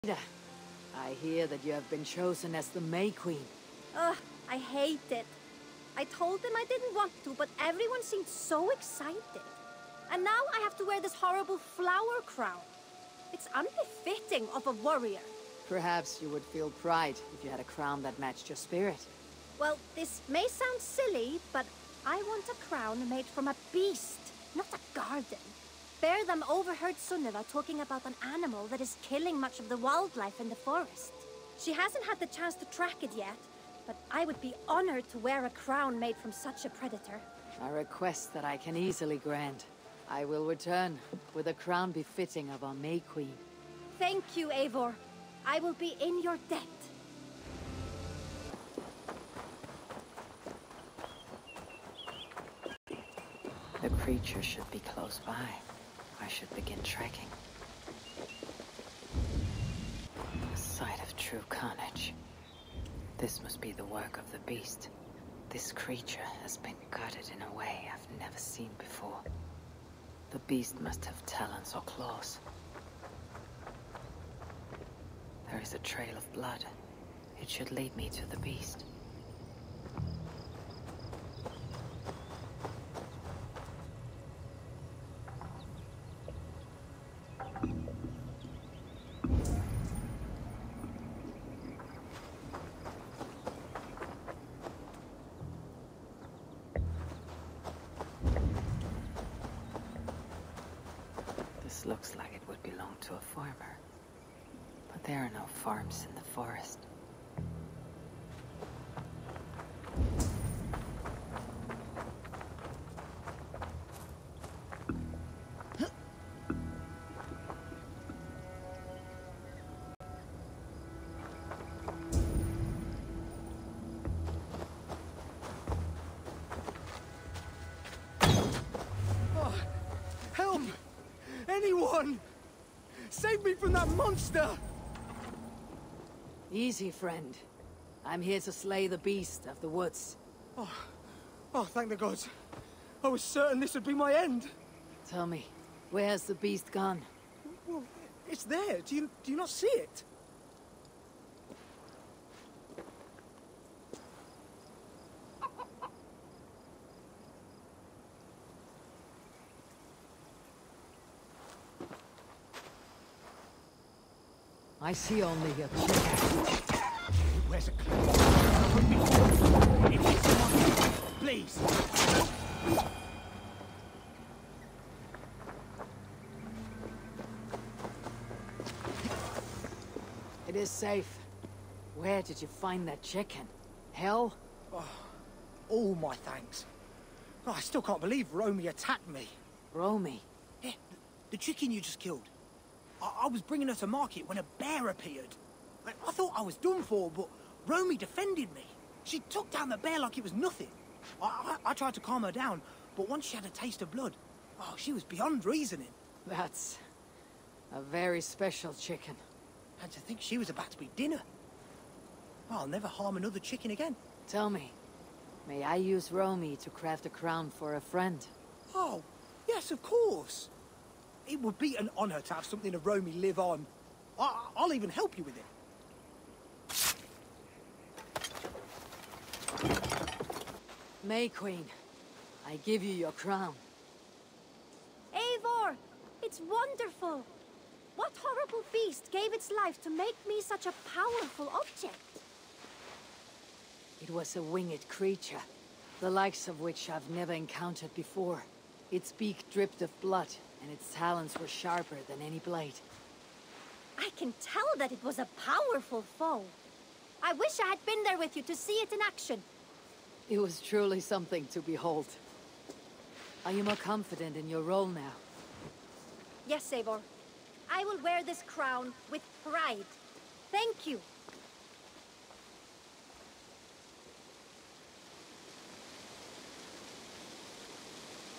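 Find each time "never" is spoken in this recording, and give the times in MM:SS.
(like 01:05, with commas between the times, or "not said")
01:08, 03:32, 04:07.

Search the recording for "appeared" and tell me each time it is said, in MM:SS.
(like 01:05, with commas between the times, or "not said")
03:14.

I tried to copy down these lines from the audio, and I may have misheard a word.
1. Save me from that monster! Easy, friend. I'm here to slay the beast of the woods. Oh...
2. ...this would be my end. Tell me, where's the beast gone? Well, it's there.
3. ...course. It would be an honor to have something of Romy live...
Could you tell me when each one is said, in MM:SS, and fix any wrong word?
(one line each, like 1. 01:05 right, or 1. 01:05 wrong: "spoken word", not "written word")
1. 02:13 right
2. 02:23 right
3. 03:39 right.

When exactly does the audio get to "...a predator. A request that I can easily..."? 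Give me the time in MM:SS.
00:36.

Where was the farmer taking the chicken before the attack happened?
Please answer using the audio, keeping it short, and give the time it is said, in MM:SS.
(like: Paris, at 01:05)
To market, at 03:13.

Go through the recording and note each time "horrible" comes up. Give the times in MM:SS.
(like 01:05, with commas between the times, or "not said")
00:11, 03:58.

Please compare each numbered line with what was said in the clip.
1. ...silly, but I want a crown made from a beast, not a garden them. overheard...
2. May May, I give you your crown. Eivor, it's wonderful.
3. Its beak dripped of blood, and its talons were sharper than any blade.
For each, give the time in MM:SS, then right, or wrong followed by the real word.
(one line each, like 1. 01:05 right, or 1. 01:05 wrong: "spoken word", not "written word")
1. 00:20 right
2. 03:51 wrong: "Queen", not "May"
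3. 04:08 right.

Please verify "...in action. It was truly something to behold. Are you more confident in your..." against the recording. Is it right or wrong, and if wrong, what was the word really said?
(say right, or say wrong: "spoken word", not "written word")
right.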